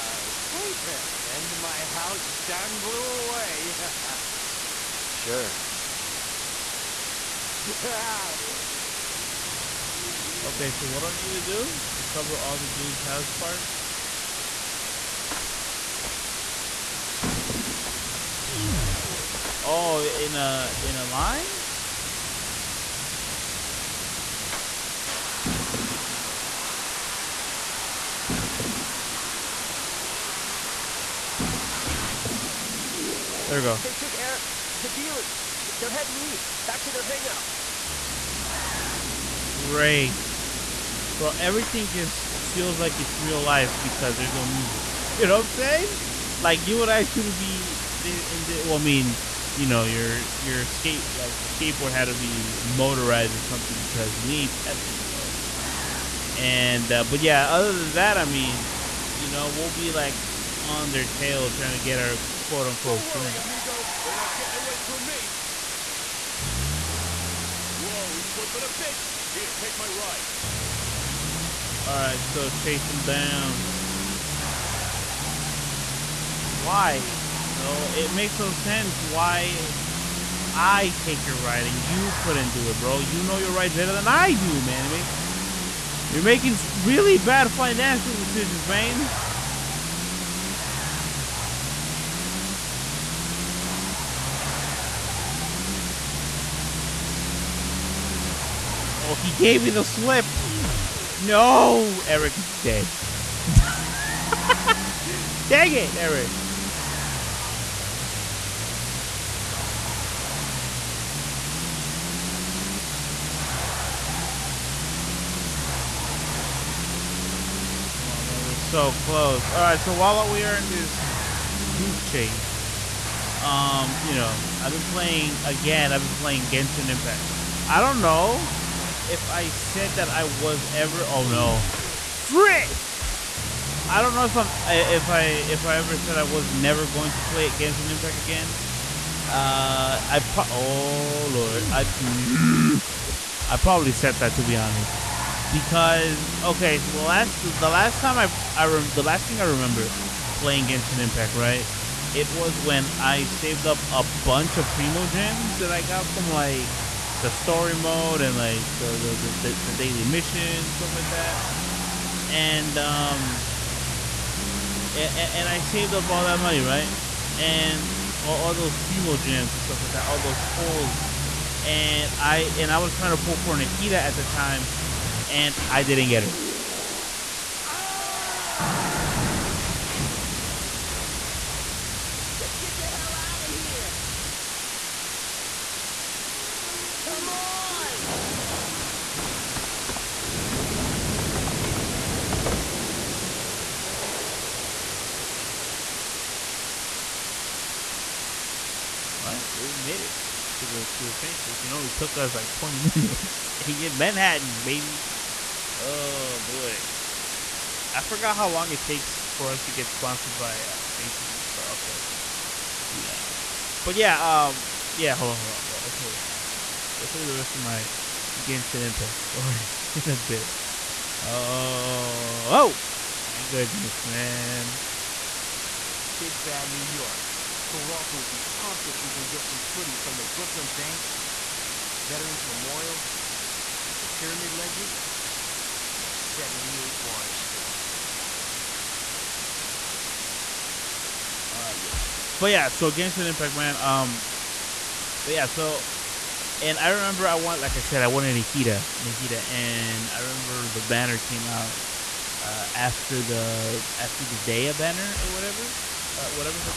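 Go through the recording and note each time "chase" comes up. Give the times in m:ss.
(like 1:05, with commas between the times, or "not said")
1:12, 2:02.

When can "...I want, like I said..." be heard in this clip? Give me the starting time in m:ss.
4:07.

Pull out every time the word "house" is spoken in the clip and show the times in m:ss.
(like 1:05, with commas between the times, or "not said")
0:01, 0:13.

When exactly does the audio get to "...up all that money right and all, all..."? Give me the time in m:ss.
2:45.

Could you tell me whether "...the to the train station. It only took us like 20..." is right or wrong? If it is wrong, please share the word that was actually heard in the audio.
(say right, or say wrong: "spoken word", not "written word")
right.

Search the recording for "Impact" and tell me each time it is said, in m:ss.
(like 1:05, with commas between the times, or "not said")
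2:06, 2:17, 2:30, 3:38, 4:03.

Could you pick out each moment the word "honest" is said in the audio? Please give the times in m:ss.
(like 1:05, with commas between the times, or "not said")
2:24, 3:33.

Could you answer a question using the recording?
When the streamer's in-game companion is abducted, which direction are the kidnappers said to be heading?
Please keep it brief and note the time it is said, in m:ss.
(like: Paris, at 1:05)
East, at 0:35.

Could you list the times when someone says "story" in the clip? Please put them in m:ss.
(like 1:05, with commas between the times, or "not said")
2:37, 3:39.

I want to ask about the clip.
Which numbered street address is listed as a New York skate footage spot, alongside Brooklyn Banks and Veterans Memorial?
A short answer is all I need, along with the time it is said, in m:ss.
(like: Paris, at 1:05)
78 Water Street, at 3:56.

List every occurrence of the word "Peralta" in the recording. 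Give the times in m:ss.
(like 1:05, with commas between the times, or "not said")
3:31, 3:47.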